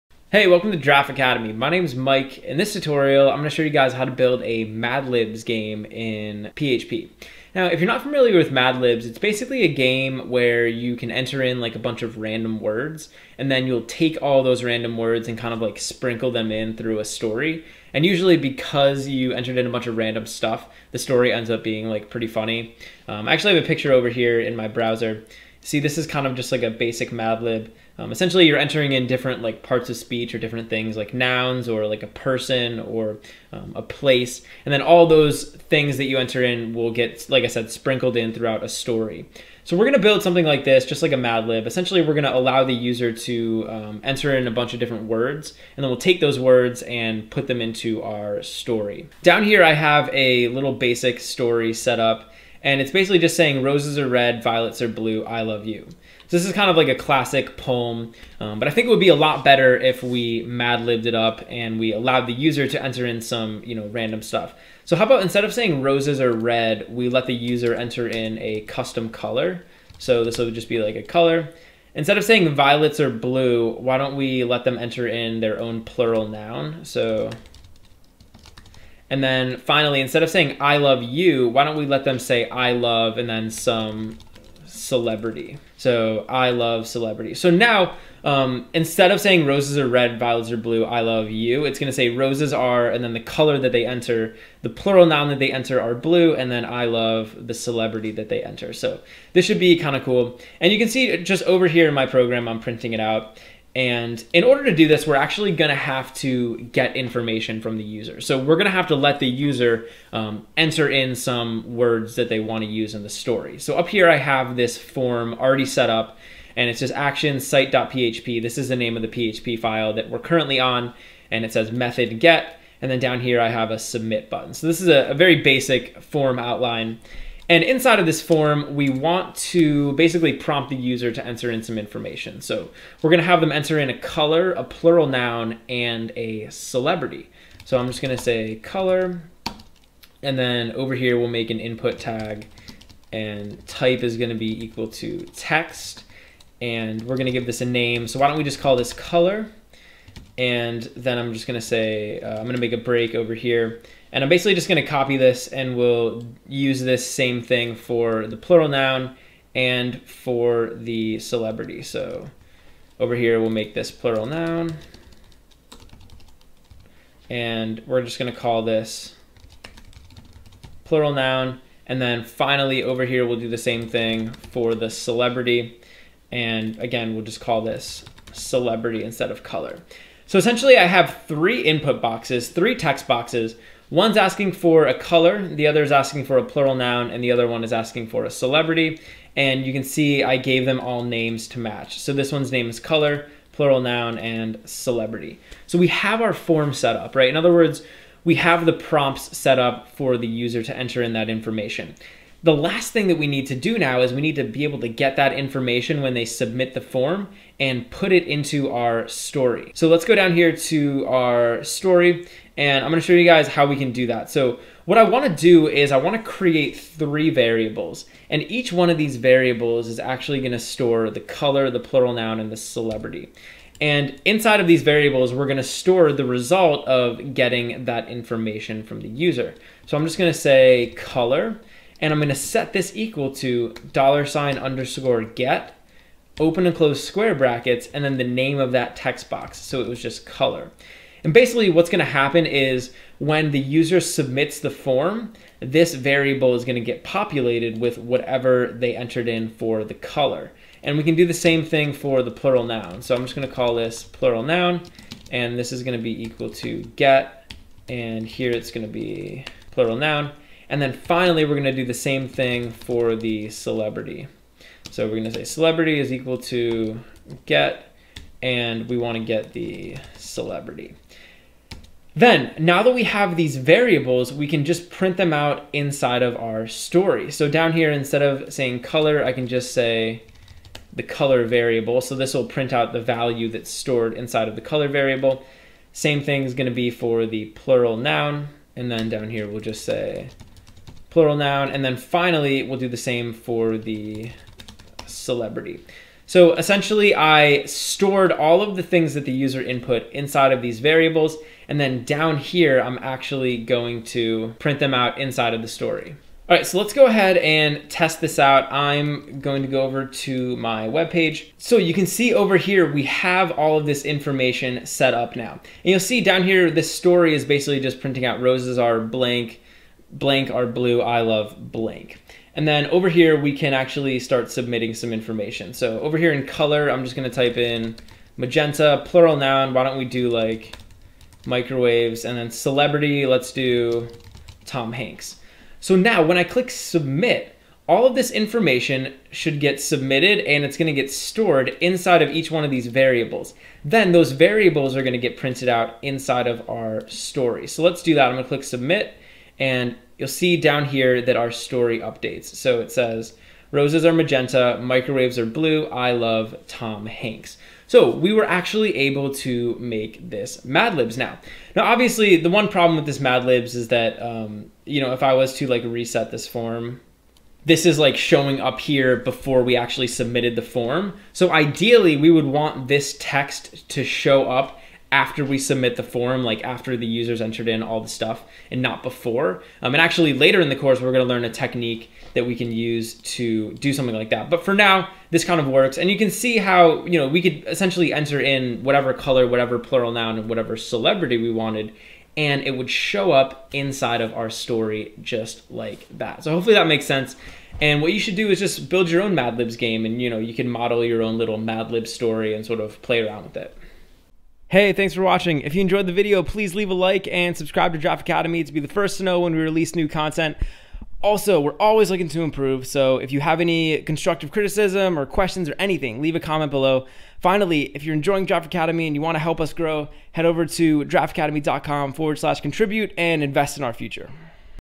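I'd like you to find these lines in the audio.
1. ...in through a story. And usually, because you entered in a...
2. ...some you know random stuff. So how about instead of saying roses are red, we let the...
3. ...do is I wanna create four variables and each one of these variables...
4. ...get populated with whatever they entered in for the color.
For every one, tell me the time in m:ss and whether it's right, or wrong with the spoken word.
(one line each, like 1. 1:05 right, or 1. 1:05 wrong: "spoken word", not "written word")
1. 0:16 right
2. 1:03 right
3. 3:35 wrong: "three", not "four"
4. 4:06 right.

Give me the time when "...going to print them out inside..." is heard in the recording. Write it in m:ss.
5:03.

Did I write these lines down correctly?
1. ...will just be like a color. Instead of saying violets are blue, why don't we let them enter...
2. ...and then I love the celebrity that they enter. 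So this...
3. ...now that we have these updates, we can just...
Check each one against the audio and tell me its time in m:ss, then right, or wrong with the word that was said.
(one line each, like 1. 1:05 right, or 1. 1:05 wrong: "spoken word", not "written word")
1. 1:10 right
2. 1:36 right
3. 4:32 wrong: "variables", not "updates".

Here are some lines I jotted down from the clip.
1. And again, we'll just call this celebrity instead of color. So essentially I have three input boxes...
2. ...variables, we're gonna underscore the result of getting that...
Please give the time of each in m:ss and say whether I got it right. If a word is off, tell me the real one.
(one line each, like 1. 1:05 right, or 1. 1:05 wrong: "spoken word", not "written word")
1. 2:56 right
2. 3:44 wrong: "store", not "underscore".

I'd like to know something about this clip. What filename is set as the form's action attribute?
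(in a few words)
site.php.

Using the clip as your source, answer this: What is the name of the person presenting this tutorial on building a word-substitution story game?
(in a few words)
Mike.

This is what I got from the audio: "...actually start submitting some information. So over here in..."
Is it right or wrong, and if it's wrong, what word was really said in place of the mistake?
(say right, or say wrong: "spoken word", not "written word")
right.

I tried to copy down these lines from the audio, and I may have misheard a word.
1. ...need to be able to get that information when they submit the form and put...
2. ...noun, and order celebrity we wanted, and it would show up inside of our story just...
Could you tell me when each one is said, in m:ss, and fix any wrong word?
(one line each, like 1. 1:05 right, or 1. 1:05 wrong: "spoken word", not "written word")
1. 3:24 right
2. 6:30 wrong: "whatever", not "order".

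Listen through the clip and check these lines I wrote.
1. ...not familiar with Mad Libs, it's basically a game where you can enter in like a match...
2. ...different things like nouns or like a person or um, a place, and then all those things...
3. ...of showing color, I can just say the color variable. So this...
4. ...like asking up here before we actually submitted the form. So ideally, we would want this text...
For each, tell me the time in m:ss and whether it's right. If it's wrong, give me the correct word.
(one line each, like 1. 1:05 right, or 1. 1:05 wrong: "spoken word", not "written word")
1. 0:07 wrong: "bunch", not "match"
2. 0:30 right
3. 4:38 wrong: "saying", not "showing"
4. 6:07 wrong: "showing", not "asking".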